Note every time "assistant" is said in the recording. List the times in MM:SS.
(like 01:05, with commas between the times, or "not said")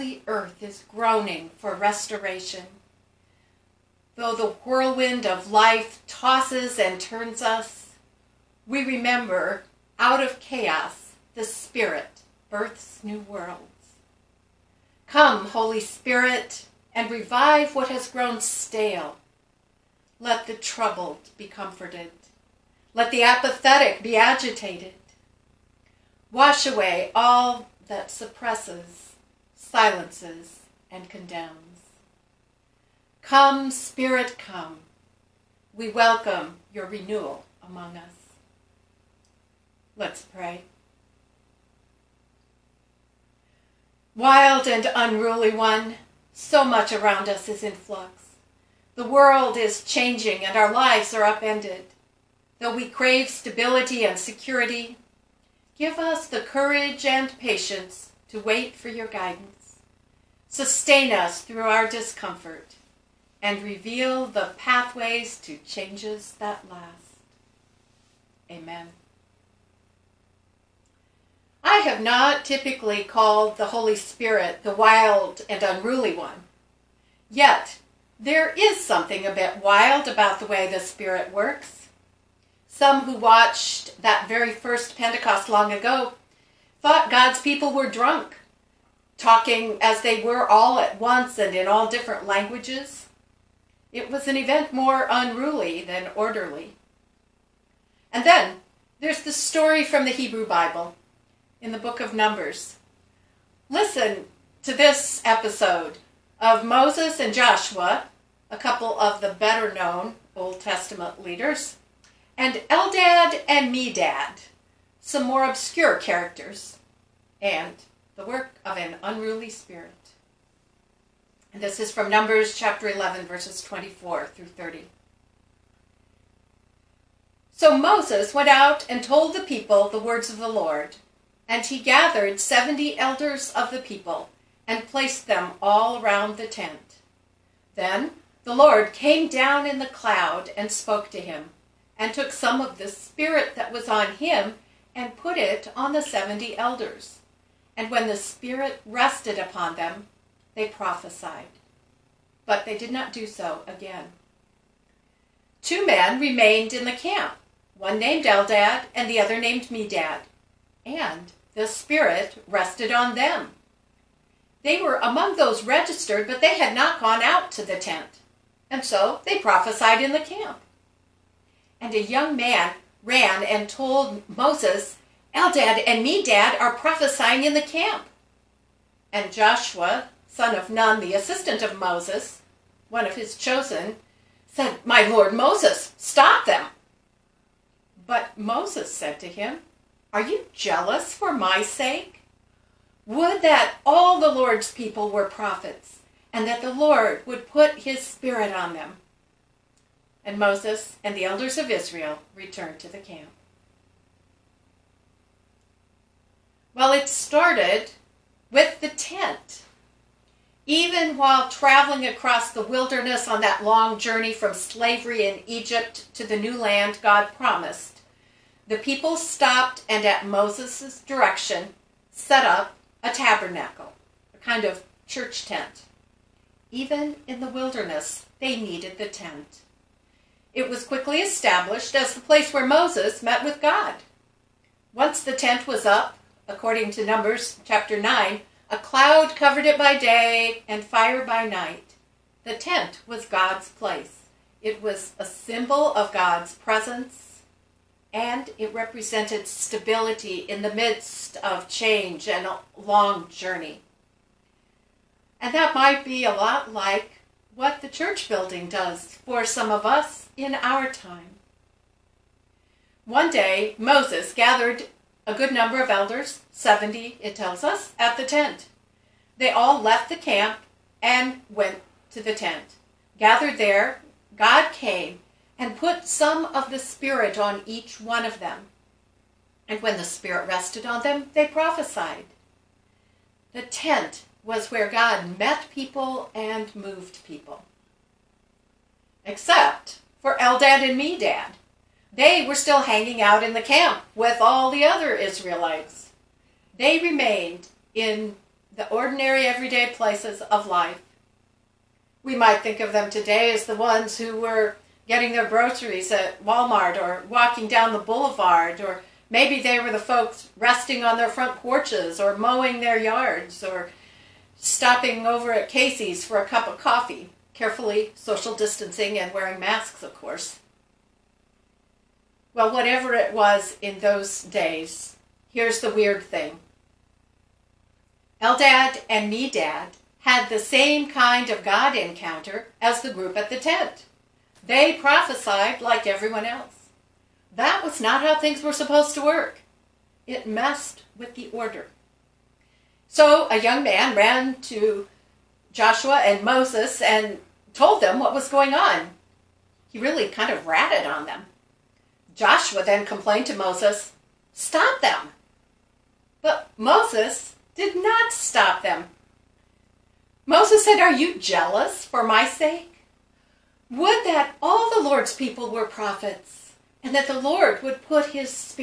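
03:01.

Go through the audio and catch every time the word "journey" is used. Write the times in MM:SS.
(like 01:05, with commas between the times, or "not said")
03:33, 04:13.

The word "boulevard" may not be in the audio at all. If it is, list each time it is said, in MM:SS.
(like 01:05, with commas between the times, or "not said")
05:07.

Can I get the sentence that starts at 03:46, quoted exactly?
Even in the wilderness, they needed the tent.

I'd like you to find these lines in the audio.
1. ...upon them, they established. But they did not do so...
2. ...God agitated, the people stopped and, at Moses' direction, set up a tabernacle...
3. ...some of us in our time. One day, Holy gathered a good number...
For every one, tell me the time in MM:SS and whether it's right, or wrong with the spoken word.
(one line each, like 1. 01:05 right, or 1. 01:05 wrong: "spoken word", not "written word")
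1. 02:29 wrong: "prophesied", not "established"
2. 03:37 wrong: "promised", not "agitated"
3. 04:19 wrong: "Moses", not "Holy".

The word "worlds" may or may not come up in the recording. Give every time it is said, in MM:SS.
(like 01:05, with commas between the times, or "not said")
00:13, 00:49.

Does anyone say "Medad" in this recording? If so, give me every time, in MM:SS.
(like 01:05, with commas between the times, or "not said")
01:53, 02:39, 02:56, 04:50, 05:29.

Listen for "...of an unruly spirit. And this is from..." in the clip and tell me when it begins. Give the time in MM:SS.
01:58.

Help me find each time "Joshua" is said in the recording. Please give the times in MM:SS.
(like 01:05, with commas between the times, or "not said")
01:47, 02:59, 05:45, 05:52.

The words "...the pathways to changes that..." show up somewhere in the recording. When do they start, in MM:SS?
01:04.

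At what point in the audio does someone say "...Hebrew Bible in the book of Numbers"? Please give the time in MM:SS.
01:40.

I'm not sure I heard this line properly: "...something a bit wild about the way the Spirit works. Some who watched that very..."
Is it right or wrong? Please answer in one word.
right.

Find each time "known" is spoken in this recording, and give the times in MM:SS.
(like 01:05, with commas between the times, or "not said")
01:49.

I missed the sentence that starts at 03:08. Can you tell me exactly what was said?
But Moses said to him, are you jealous for my sake?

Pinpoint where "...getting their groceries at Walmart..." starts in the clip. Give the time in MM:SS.
05:05.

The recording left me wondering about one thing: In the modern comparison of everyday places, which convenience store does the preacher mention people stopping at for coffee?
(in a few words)
Casey's.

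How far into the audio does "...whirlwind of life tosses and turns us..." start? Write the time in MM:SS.
00:04.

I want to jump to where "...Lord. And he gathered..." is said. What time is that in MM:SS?
02:10.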